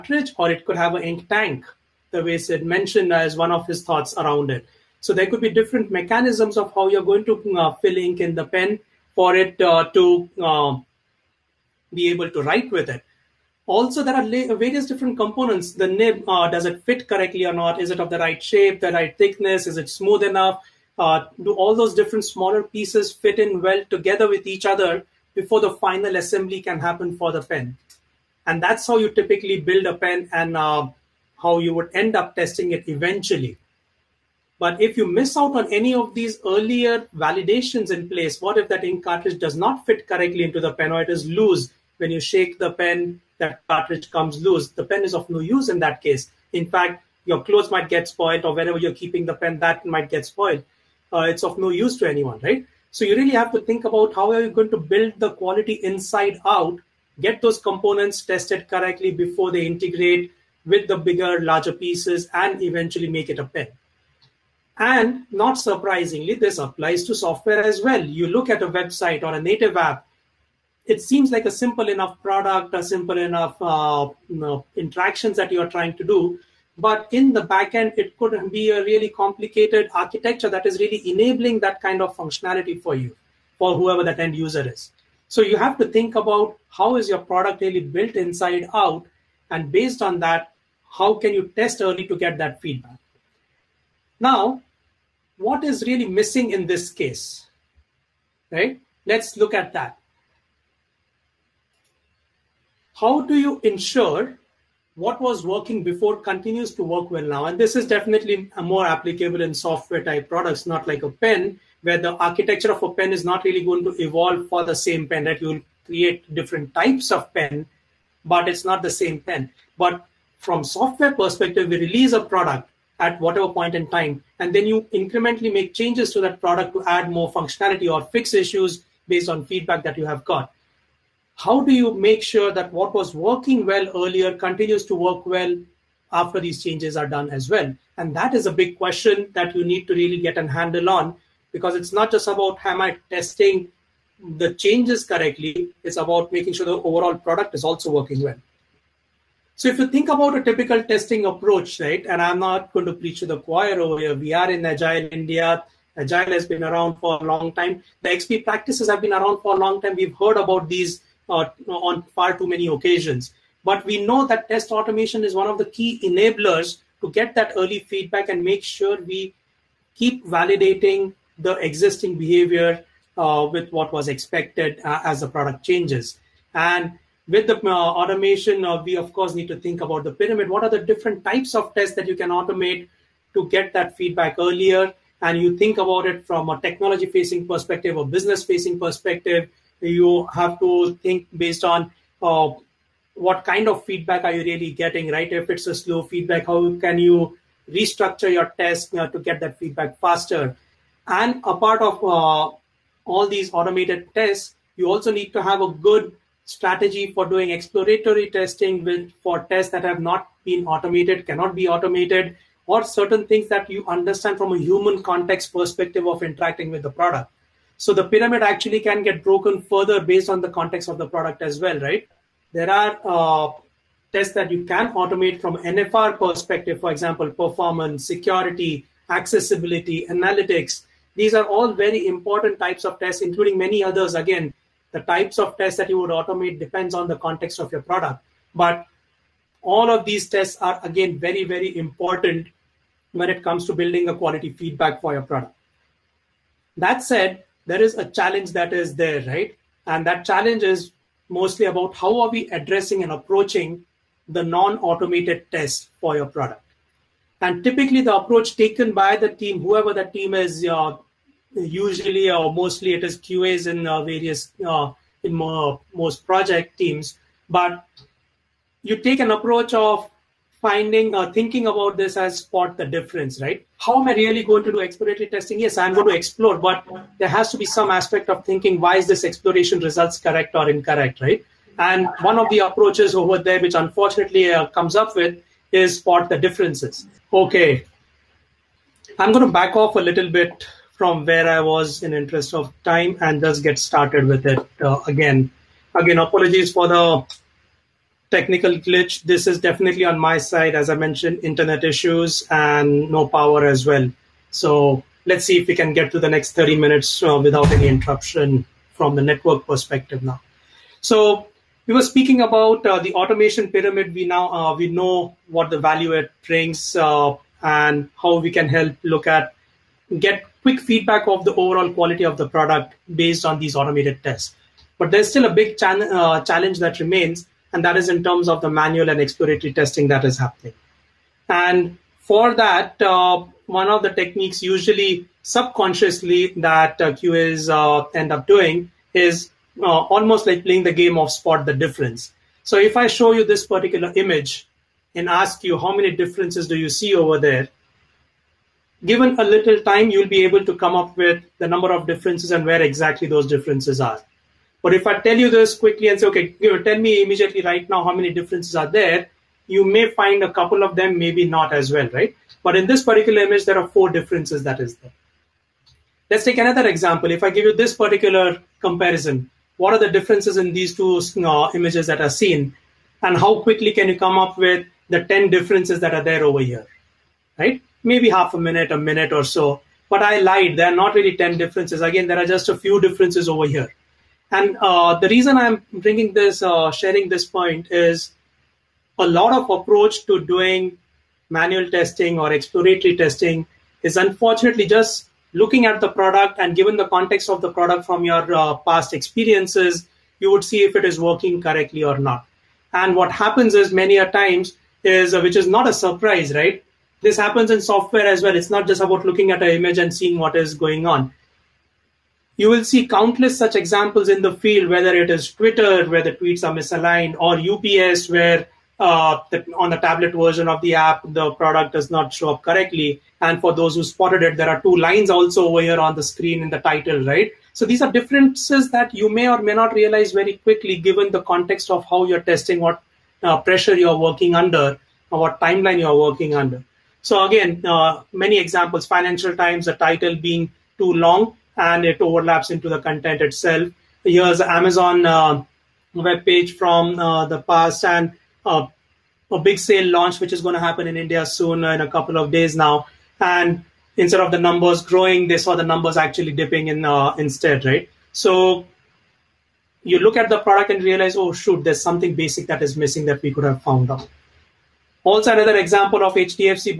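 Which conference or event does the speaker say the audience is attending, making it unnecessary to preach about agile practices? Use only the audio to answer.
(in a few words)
Agile India.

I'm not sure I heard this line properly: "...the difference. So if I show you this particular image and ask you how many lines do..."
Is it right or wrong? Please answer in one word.
wrong.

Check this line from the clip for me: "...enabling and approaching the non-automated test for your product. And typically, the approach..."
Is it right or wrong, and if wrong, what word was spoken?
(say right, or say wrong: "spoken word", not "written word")
wrong: "addressing", not "enabling".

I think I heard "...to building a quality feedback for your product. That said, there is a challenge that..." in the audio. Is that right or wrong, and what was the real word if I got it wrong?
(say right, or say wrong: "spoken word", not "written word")
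right.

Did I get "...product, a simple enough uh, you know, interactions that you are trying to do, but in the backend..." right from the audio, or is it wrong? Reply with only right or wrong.
right.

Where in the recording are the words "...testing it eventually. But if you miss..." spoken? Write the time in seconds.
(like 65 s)
32 s.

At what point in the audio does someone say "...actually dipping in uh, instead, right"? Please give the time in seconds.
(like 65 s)
456 s.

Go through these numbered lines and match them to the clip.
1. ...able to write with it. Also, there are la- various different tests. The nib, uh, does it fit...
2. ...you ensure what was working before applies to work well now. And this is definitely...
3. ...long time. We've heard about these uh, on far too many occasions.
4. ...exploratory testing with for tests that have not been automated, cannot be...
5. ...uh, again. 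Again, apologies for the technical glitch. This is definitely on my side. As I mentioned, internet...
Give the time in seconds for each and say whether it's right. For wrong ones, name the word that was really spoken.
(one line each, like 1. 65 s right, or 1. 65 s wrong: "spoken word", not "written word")
1. 12 s wrong: "components", not "tests"
2. 103 s wrong: "continues", not "applies"
3. 159 s right
4. 207 s right
5. 294 s right.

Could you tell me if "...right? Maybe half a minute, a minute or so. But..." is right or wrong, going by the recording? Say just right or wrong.
right.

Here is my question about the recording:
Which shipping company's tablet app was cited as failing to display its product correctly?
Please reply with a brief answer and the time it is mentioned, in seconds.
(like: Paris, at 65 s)
UPS, at 417 s.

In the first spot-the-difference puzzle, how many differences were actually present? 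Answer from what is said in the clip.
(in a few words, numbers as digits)
4.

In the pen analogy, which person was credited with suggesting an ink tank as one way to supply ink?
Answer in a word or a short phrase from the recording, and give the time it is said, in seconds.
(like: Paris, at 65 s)
Sid, at 2 s.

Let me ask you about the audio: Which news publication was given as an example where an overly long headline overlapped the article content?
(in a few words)
Financial Times.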